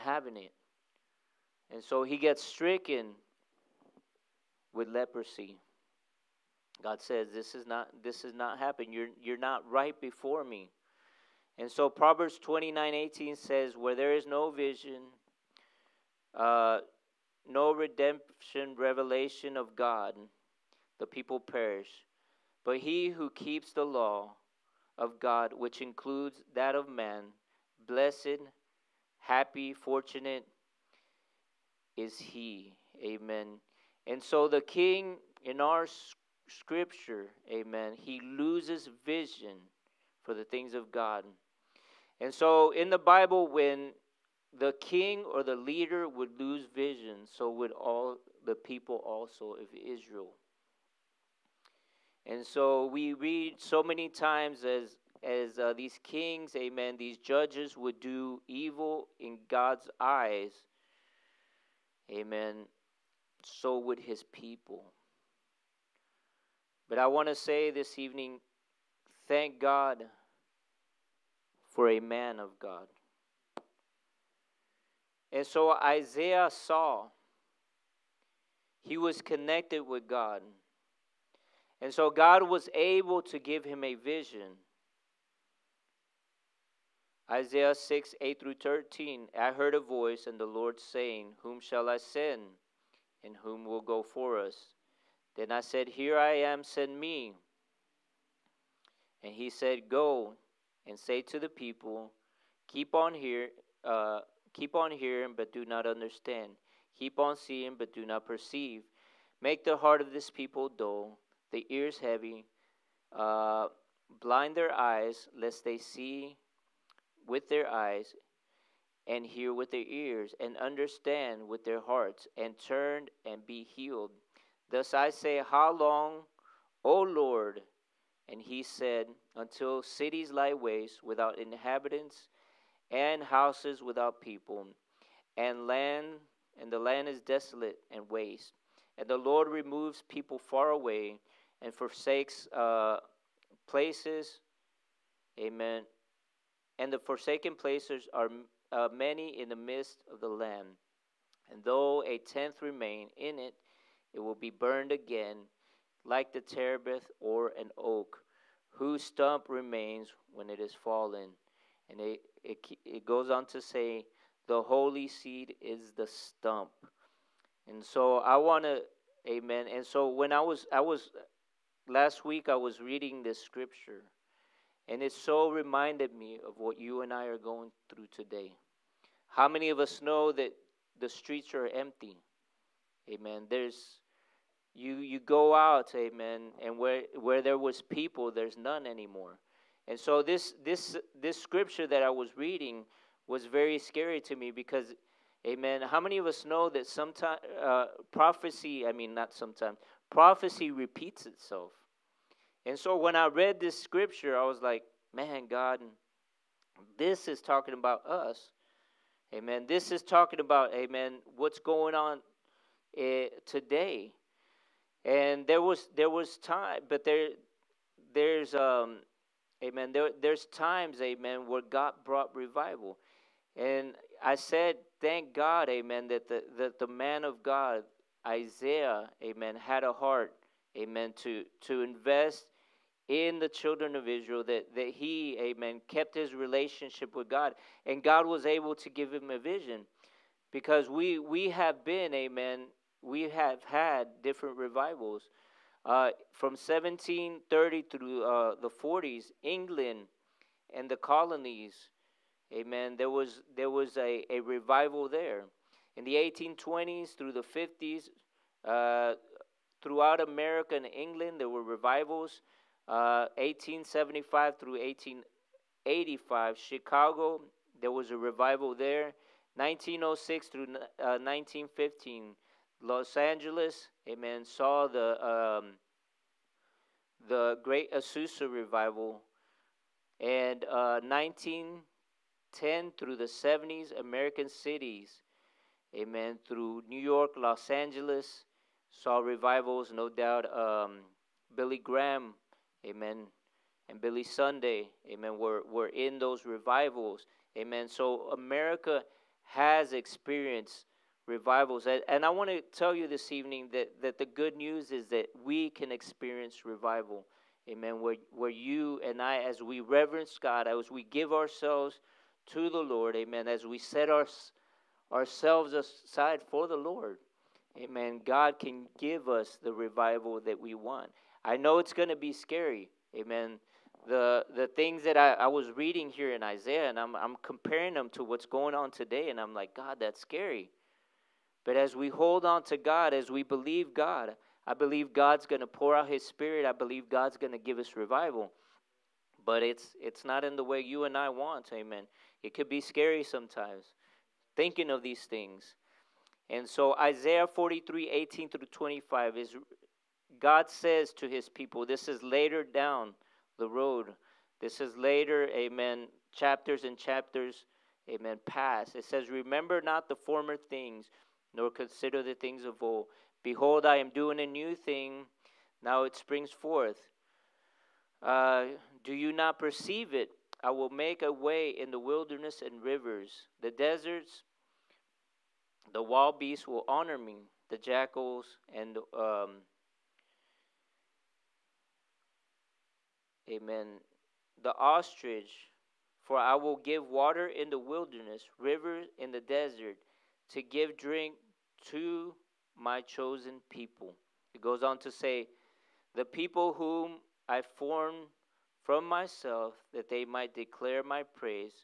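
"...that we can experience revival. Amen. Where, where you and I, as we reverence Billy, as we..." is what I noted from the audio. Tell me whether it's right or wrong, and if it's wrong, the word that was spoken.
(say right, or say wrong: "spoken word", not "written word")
wrong: "God", not "Billy".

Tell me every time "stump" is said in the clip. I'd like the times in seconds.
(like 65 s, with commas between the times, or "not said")
159 s, 166 s.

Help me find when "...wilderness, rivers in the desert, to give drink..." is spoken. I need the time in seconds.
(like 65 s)
387 s.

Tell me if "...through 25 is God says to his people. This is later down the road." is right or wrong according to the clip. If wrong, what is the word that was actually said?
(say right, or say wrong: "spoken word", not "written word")
right.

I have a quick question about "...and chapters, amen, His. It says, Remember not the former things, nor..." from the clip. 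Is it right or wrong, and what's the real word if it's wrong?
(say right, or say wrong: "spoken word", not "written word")
wrong: "Pass", not "His".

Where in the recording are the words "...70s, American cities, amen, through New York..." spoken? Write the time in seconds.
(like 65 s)
283 s.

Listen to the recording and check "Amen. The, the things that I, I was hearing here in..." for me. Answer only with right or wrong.
wrong.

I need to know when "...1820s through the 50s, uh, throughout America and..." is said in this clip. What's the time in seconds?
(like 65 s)
256 s.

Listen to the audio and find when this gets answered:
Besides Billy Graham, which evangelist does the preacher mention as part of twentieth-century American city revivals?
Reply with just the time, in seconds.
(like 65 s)
294 s.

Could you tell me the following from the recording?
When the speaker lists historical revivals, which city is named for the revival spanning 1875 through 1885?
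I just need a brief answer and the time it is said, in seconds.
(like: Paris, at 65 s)
Chicago, at 266 s.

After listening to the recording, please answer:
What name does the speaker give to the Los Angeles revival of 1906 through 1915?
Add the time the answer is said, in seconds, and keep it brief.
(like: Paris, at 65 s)
Great Azusa revival, at 277 s.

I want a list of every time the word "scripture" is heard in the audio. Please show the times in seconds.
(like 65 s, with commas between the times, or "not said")
36 s, 173 s, 191 s, 203 s.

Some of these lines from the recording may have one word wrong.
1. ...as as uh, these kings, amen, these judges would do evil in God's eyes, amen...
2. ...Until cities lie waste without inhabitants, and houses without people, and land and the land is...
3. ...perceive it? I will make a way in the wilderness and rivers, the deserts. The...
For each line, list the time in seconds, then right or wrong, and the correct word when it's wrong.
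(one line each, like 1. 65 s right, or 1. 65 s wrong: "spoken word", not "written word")
1. 54 s right
2. 129 s right
3. 369 s right.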